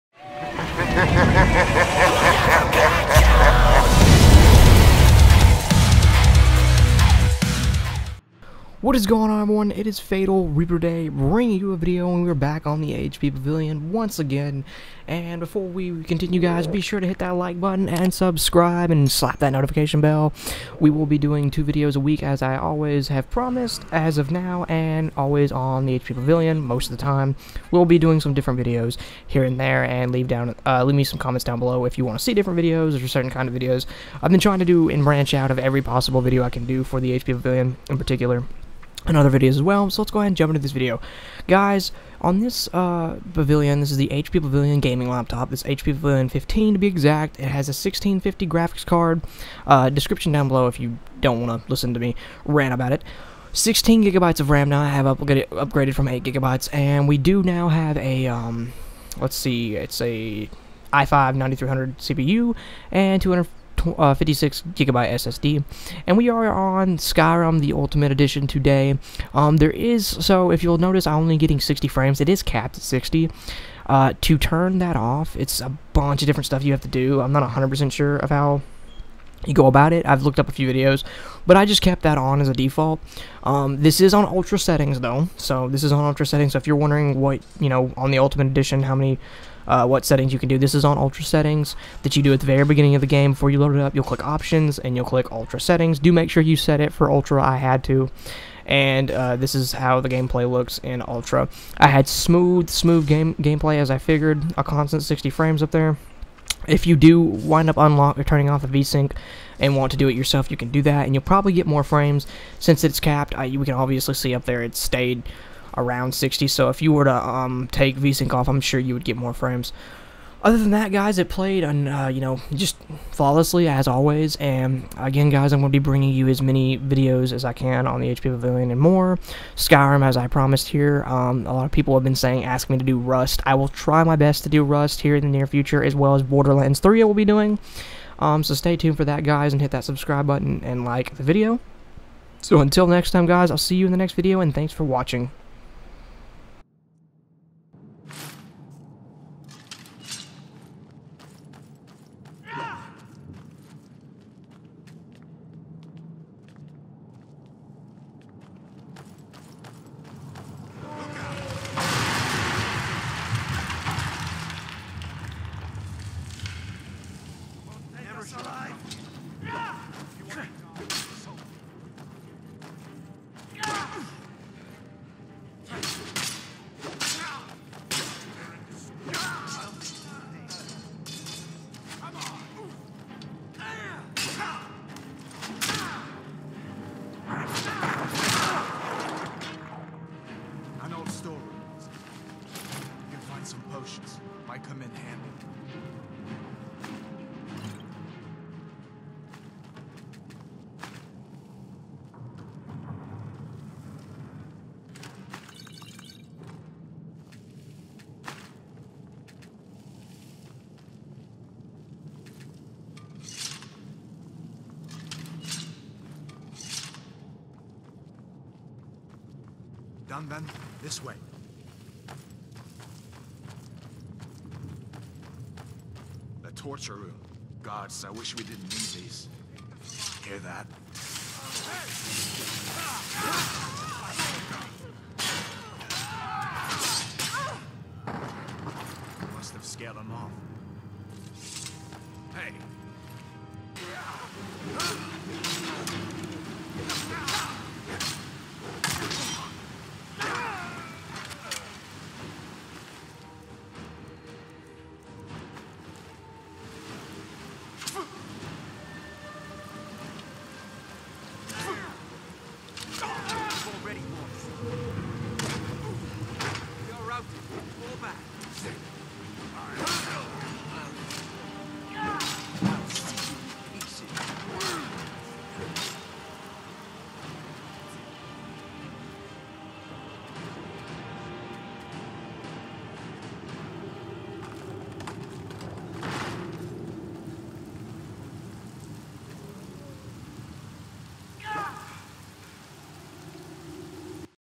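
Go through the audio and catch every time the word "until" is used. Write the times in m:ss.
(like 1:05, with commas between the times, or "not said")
2:22.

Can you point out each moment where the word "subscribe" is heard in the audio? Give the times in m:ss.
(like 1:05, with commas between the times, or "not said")
0:18, 2:19.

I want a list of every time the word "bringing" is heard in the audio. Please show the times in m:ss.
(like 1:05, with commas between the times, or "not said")
0:11, 2:05.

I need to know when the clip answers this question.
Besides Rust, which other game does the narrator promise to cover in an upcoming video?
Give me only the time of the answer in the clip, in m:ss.
2:16.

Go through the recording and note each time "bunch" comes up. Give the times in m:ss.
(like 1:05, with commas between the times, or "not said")
1:15.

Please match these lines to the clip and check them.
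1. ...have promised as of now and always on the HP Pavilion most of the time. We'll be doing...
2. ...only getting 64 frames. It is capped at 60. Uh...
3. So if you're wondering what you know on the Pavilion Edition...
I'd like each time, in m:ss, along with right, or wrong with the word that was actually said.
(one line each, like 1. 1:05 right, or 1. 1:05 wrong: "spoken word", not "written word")
1. 0:23 right
2. 1:11 wrong: "60", not "64"
3. 1:26 wrong: "Ultimate", not "Pavilion".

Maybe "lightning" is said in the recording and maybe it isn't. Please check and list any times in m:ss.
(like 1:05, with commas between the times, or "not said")
not said.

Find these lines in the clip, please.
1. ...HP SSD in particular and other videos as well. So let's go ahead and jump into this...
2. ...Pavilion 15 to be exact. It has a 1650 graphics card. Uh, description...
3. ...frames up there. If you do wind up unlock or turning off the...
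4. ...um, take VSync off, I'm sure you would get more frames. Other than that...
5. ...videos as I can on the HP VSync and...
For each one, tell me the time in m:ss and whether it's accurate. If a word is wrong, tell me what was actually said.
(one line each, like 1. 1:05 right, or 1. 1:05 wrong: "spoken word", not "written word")
1. 0:37 wrong: "Pavilion", not "SSD"
2. 0:45 right
3. 1:45 right
4. 1:57 right
5. 2:06 wrong: "Pavilion", not "VSync".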